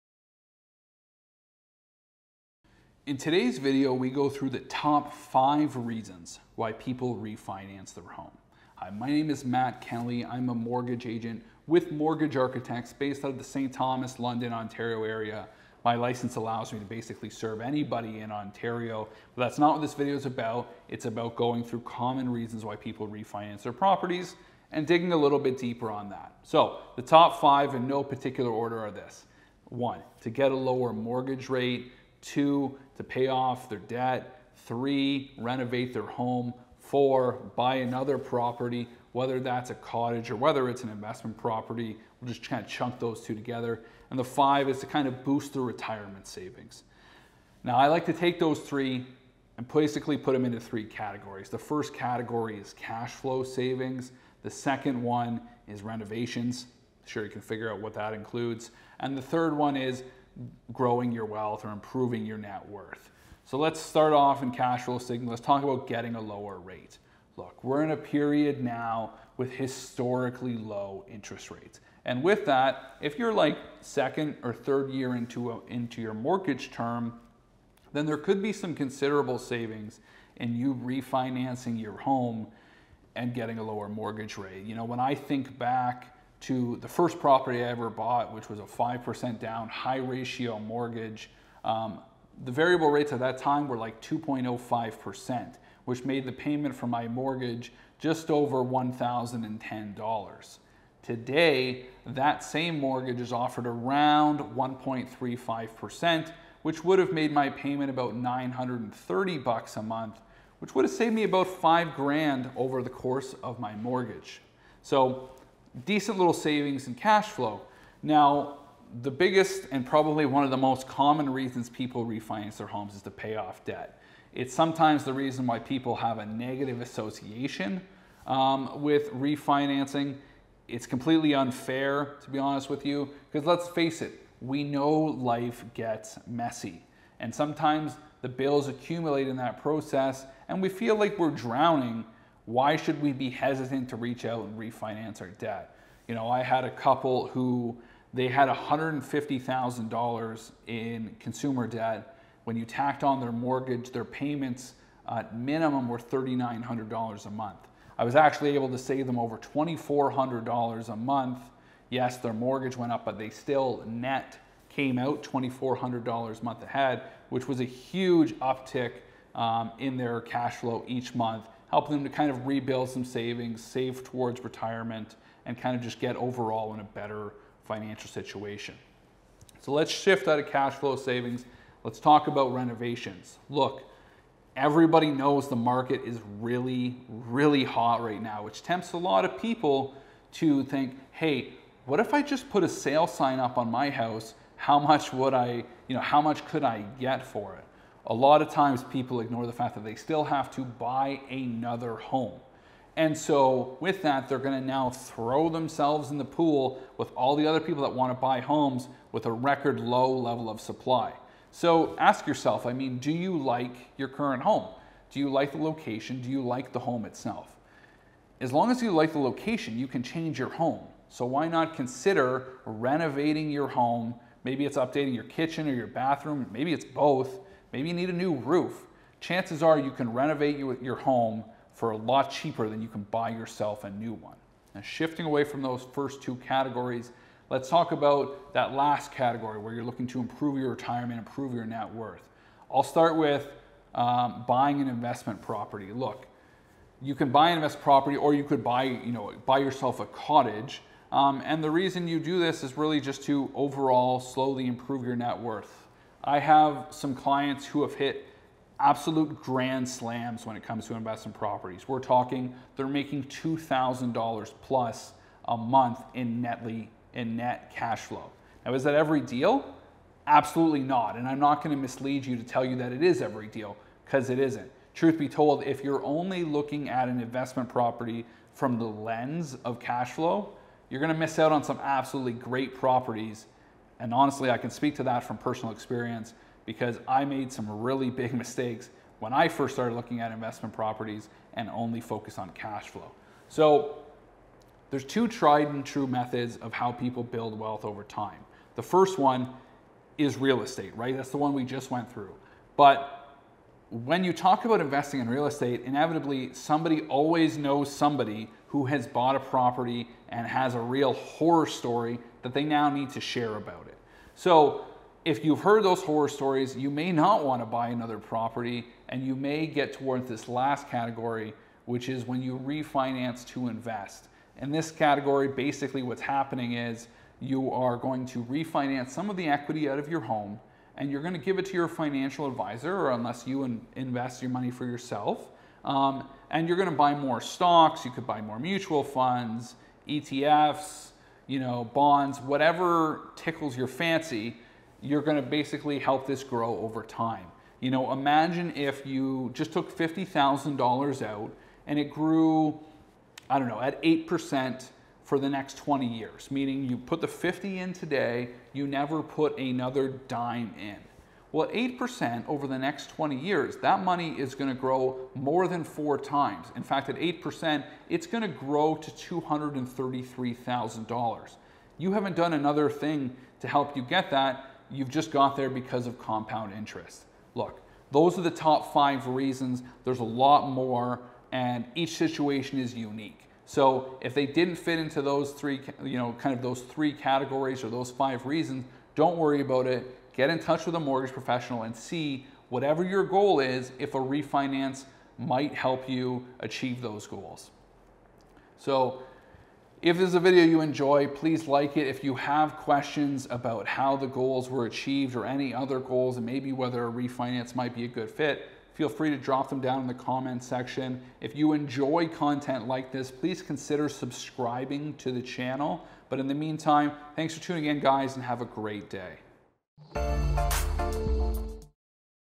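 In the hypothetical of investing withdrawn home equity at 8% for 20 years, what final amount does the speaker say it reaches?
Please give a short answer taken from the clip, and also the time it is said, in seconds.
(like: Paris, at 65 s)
$233,000, at 369 s.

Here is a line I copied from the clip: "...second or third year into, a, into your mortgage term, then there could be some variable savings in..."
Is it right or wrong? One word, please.
wrong.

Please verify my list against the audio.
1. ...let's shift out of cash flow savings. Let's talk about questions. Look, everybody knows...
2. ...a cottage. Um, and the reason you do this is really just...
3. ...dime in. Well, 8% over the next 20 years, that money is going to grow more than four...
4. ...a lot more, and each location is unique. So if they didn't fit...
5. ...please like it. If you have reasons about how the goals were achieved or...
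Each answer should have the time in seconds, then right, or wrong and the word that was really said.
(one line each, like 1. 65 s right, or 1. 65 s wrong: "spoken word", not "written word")
1. 179 s wrong: "renovations", not "questions"
2. 249 s right
3. 360 s right
4. 380 s wrong: "situation", not "location"
5. 401 s wrong: "questions", not "reasons".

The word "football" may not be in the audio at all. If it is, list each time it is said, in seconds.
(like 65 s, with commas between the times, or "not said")
not said.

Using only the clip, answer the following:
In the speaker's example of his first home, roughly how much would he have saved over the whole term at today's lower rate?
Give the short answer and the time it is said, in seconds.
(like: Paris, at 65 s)
5 grand, at 111 s.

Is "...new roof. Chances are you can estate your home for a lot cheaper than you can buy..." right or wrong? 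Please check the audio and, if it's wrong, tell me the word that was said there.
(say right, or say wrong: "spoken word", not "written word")
wrong: "renovate", not "estate".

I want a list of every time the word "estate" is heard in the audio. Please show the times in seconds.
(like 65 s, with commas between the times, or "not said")
300 s, 305 s.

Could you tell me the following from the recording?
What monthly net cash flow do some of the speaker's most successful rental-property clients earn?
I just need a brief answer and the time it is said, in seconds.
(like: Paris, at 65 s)
$2,000 plus, at 263 s.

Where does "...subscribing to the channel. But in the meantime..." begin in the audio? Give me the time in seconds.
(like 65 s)
414 s.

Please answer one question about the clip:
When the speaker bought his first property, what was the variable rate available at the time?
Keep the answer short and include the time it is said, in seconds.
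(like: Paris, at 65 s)
2.05%, at 94 s.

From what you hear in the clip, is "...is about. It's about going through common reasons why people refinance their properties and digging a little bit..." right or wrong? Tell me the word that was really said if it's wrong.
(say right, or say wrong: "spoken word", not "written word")
right.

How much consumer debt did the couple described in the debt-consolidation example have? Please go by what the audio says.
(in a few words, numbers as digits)
$150,000.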